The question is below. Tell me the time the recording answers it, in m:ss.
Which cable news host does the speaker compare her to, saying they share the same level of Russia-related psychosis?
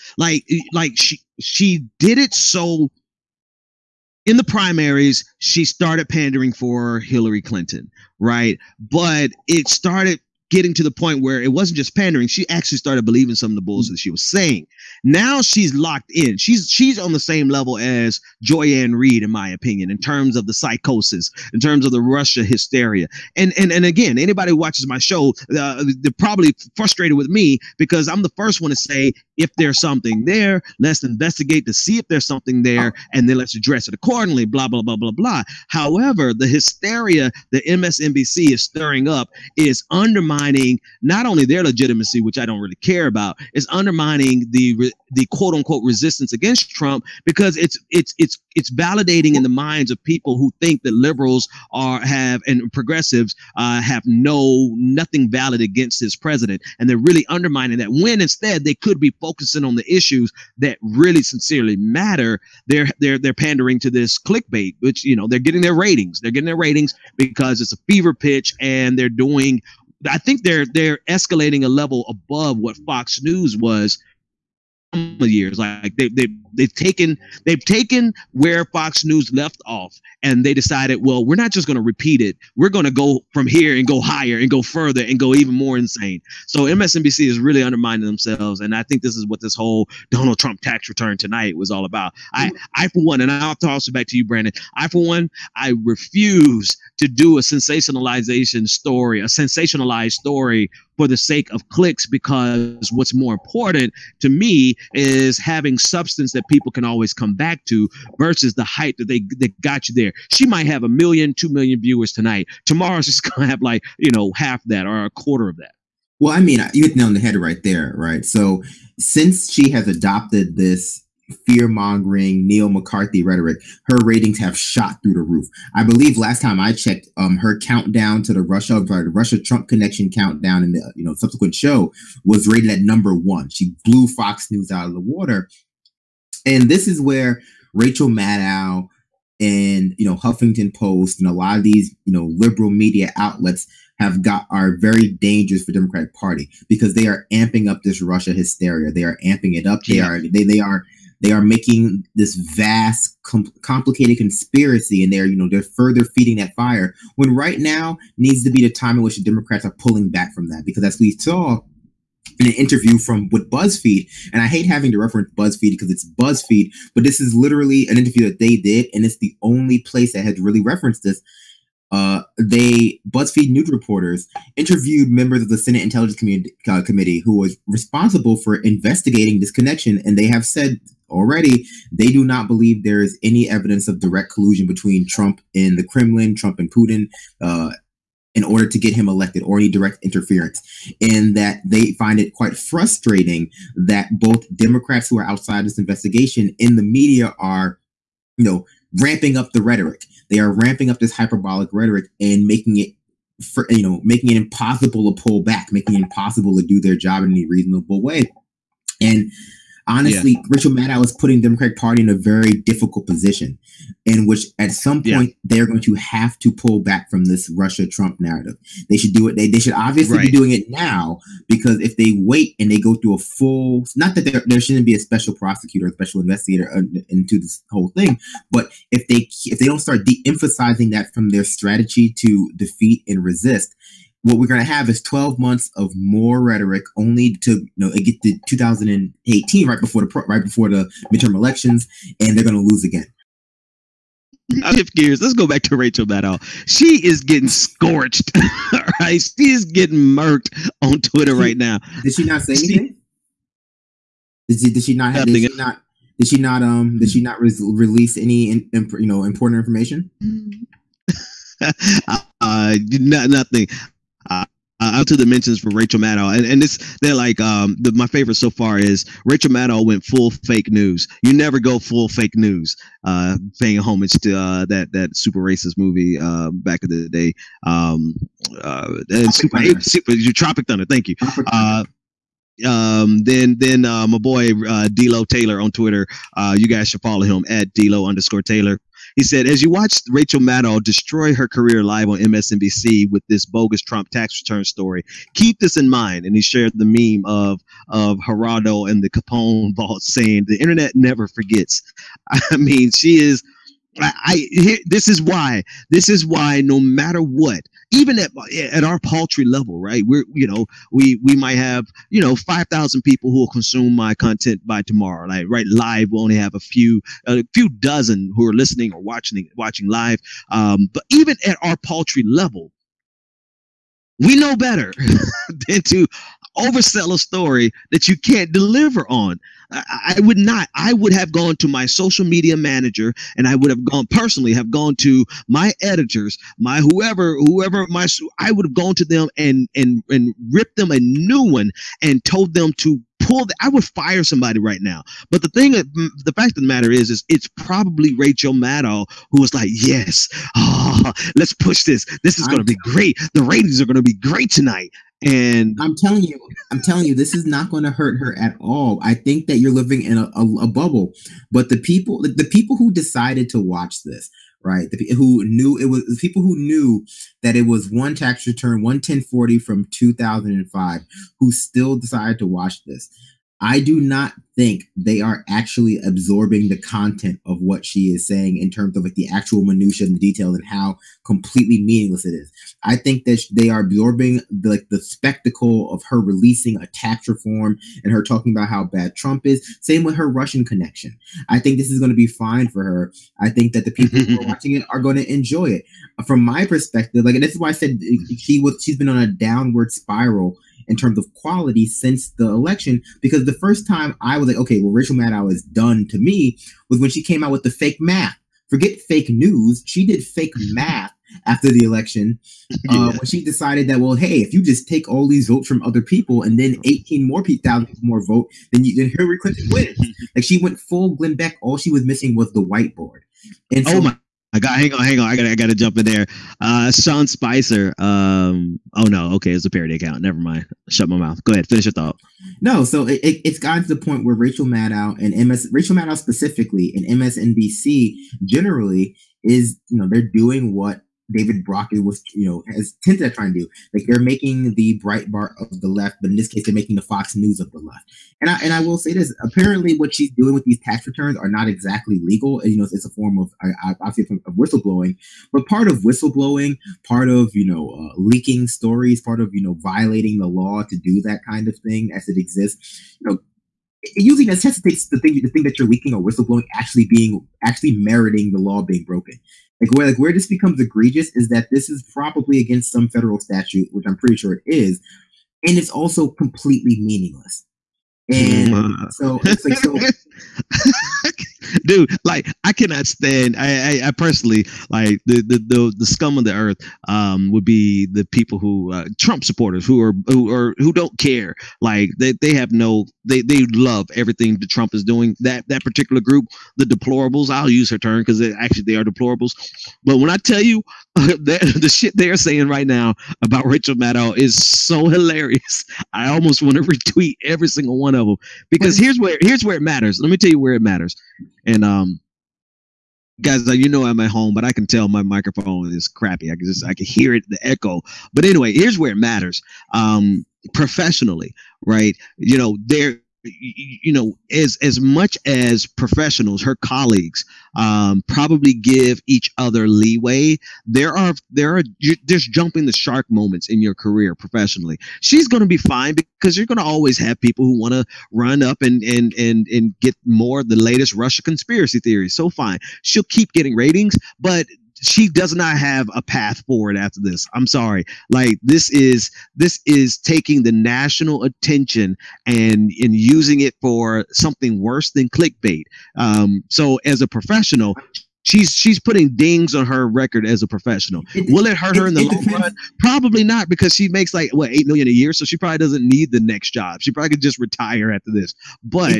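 0:18.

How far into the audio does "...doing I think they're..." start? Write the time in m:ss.
1:09.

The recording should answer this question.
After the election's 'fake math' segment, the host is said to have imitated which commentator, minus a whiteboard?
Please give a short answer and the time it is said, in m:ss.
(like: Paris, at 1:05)
Glenn Beck, at 7:01.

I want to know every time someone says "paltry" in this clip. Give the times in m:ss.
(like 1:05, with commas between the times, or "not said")
5:08, 5:21.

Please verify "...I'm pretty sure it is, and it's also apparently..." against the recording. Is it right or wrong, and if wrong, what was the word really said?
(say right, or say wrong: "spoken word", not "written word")
wrong: "completely", not "apparently".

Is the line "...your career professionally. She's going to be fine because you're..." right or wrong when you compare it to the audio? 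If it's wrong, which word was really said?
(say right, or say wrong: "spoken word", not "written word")
right.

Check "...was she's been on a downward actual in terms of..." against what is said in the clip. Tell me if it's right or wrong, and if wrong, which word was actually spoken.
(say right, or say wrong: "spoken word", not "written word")
wrong: "spiral", not "actual".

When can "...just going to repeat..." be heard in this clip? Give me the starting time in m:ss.
1:21.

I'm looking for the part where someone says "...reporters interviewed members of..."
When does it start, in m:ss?
2:53.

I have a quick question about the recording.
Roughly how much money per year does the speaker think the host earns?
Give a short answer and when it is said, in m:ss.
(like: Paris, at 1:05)
8 million, at 9:24.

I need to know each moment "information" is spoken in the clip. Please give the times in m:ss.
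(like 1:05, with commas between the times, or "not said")
4:19.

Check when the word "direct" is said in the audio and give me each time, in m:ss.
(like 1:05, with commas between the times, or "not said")
3:03, 3:09.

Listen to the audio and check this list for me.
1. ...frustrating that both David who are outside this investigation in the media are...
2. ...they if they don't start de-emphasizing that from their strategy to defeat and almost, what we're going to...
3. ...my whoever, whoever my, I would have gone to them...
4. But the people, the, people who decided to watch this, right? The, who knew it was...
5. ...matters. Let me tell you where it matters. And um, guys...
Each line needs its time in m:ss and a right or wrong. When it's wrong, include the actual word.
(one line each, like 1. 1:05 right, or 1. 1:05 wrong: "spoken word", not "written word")
1. 3:12 wrong: "Democrats", not "David"
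2. 3:49 wrong: "resist", not "almost"
3. 5:36 right
4. 6:01 right
5. 8:29 right.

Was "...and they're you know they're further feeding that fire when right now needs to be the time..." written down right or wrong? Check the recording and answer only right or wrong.
right.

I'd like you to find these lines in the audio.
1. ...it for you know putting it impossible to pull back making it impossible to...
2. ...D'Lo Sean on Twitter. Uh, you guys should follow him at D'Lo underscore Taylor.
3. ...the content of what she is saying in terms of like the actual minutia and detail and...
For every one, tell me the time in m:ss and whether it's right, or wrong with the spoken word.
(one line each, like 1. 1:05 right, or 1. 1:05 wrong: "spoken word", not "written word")
1. 3:22 wrong: "making", not "putting"
2. 4:44 wrong: "Taylor", not "Sean"
3. 6:16 right.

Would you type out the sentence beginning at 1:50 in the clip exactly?
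She might have a million, two million viewers tonight.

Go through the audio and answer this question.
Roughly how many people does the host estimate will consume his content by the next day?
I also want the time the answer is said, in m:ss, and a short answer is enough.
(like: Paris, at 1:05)
5,000, at 5:12.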